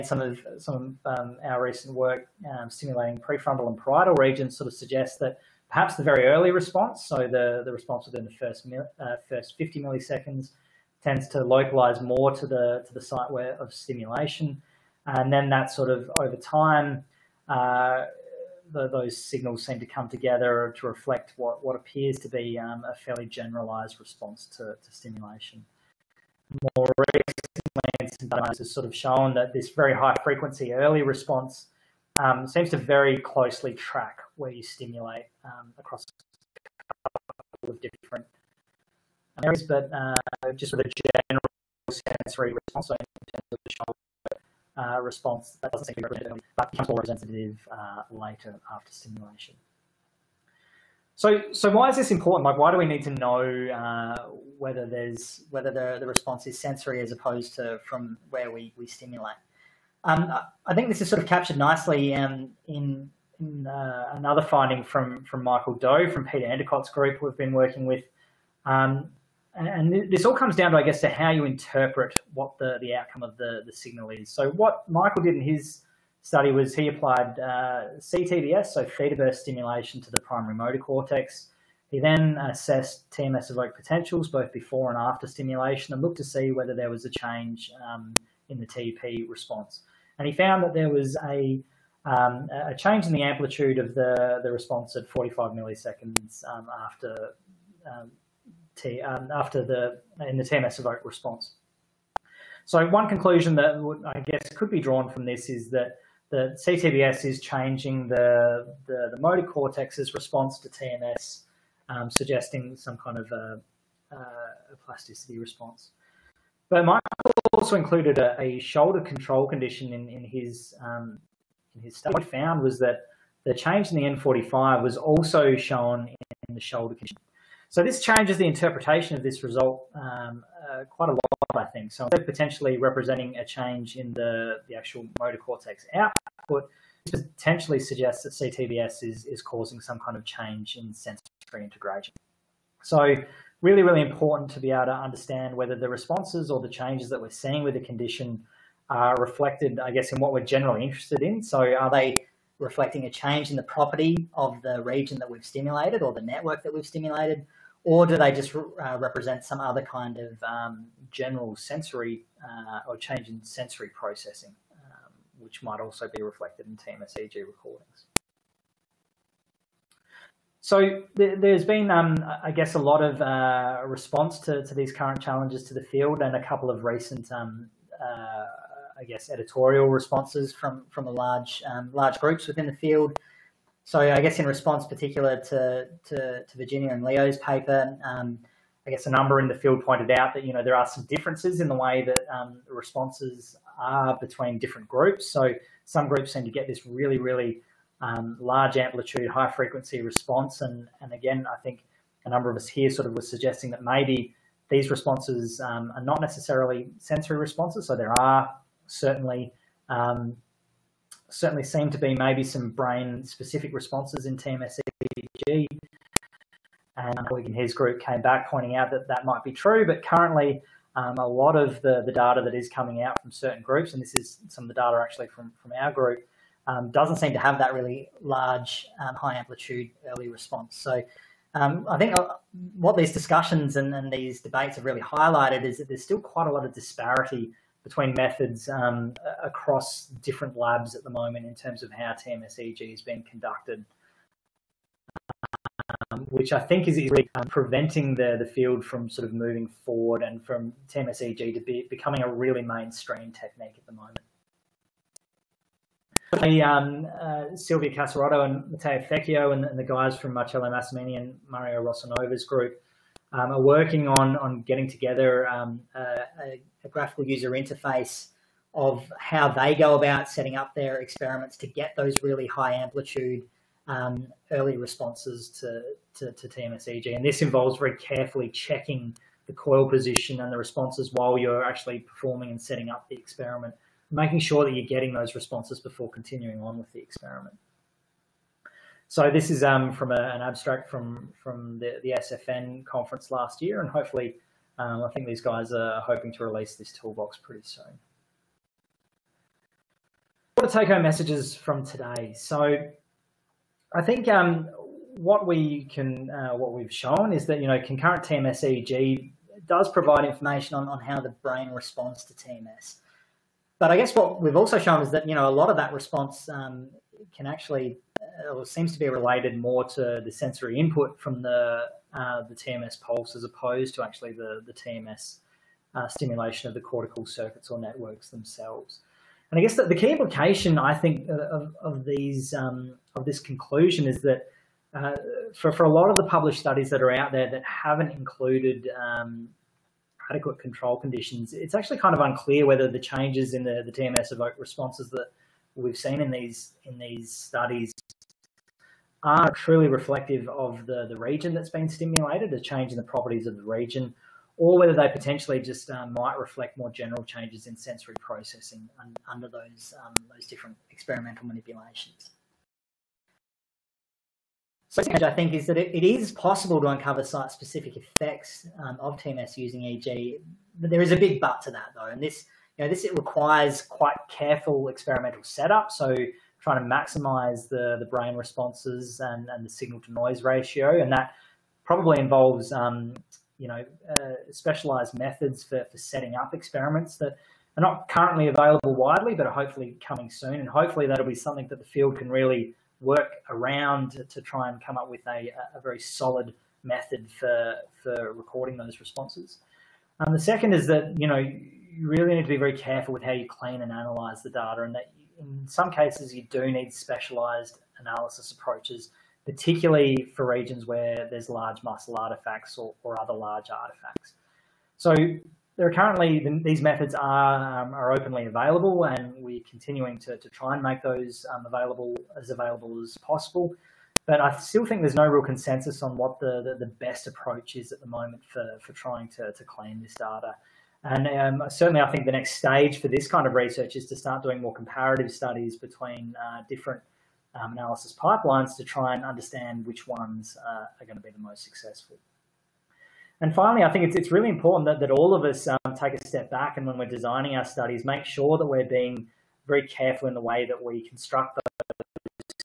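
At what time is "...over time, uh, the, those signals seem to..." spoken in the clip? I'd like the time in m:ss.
0:16.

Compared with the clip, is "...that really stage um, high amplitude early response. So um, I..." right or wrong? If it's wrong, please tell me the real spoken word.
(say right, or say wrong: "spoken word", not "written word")
wrong: "large", not "stage".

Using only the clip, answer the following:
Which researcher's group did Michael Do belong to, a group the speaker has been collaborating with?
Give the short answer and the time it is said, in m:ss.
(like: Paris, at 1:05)
Peter Enticott, at 1:06.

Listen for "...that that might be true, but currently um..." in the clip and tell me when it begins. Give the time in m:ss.
3:38.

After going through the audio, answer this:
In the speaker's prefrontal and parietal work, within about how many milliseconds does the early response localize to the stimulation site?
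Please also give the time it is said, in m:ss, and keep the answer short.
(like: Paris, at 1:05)
50, at 0:09.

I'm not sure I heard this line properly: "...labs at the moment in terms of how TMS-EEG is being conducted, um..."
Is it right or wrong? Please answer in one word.
right.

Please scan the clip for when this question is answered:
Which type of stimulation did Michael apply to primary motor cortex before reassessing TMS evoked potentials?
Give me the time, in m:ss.
1:18.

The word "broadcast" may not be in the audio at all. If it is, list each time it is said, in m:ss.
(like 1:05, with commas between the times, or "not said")
not said.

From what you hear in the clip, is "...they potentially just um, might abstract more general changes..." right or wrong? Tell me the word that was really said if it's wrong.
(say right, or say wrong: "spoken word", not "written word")
wrong: "reflect", not "abstract".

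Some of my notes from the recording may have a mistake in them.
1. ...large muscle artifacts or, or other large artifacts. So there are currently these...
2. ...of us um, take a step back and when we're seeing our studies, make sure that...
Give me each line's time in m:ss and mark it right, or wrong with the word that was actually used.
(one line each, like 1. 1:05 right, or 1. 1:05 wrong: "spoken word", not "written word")
1. 6:51 right
2. 7:25 wrong: "designing", not "seeing".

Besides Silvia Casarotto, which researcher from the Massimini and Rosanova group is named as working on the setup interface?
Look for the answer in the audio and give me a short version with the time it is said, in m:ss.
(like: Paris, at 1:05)
Matteo Fecchio, at 4:18.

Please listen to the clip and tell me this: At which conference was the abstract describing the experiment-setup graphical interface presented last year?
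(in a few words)
SFN.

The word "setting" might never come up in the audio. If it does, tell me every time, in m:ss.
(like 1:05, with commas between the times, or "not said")
4:30, 4:42, 6:25.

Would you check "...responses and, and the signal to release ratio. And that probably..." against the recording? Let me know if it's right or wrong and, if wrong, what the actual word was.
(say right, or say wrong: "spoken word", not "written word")
wrong: "noise", not "release".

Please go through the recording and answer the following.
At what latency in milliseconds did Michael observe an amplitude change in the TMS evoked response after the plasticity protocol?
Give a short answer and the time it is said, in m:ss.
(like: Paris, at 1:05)
45, at 1:35.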